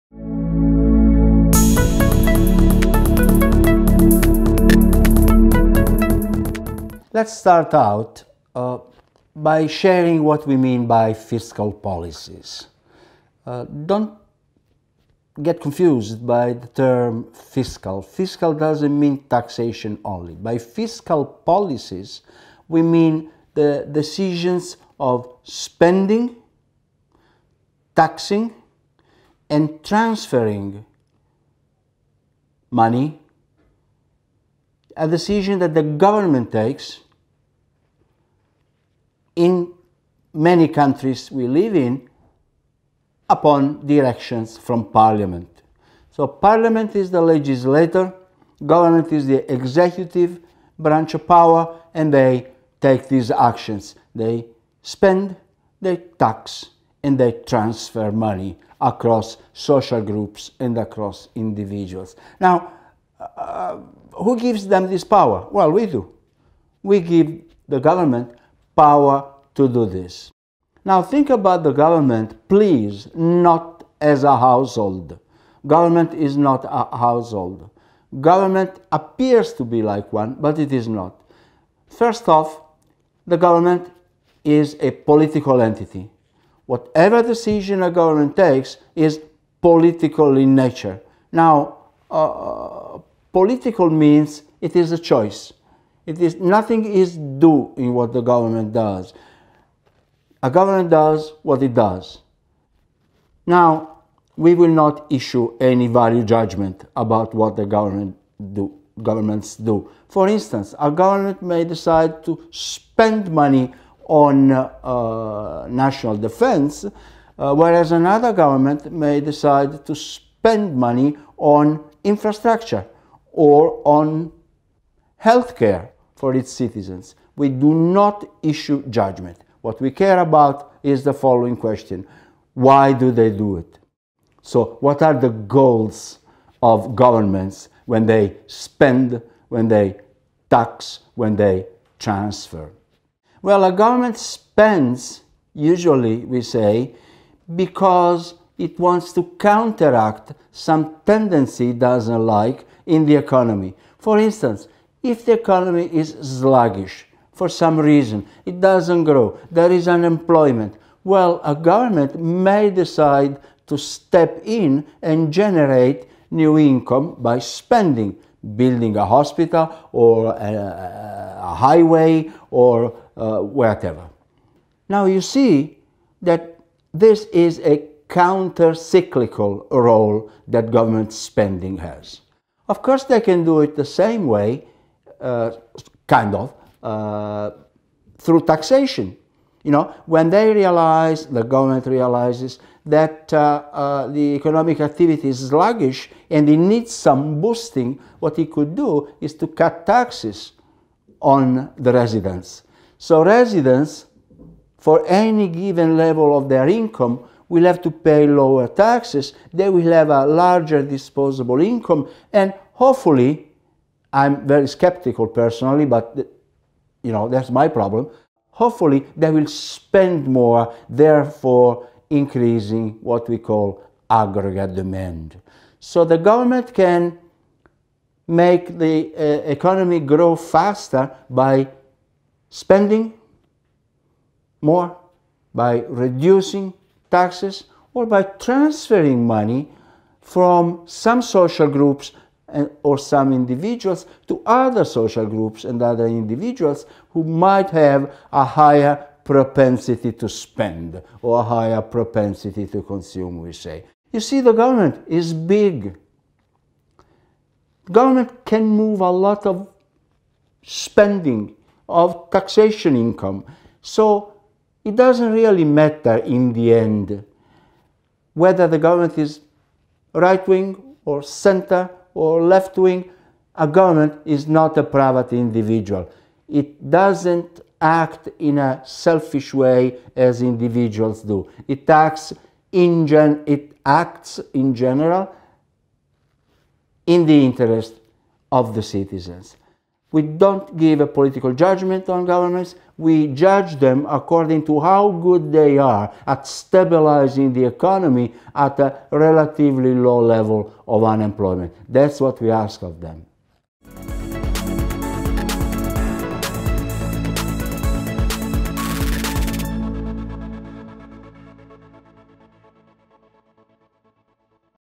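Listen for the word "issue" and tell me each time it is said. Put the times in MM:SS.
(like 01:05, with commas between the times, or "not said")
01:45, 02:08.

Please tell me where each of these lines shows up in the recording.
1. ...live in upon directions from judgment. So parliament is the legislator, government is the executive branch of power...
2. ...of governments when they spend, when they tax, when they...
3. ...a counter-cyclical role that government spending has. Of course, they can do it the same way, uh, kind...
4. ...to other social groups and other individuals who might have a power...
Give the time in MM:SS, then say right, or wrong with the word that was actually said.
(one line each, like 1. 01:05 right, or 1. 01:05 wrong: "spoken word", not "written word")
1. 00:41 wrong: "parliament", not "judgment"
2. 02:16 right
3. 02:57 right
4. 04:04 wrong: "higher", not "power".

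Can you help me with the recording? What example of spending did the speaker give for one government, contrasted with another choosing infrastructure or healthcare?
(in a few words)
National defense.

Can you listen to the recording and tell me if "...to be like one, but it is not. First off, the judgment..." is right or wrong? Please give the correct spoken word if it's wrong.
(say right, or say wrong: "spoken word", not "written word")
wrong: "government", not "judgment".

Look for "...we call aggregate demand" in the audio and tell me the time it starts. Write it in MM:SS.
03:43.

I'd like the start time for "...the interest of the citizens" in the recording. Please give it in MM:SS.
04:47.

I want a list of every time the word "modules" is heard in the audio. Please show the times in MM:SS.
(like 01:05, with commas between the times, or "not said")
not said.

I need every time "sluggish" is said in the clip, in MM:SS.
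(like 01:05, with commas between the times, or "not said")
02:36, 03:15.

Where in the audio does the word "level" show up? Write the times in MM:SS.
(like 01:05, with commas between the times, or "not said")
03:25, 05:00.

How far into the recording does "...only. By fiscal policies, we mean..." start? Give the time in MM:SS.
00:20.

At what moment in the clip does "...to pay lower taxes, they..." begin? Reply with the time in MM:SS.
03:27.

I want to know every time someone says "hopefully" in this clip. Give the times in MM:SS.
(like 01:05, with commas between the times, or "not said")
03:32, 03:38.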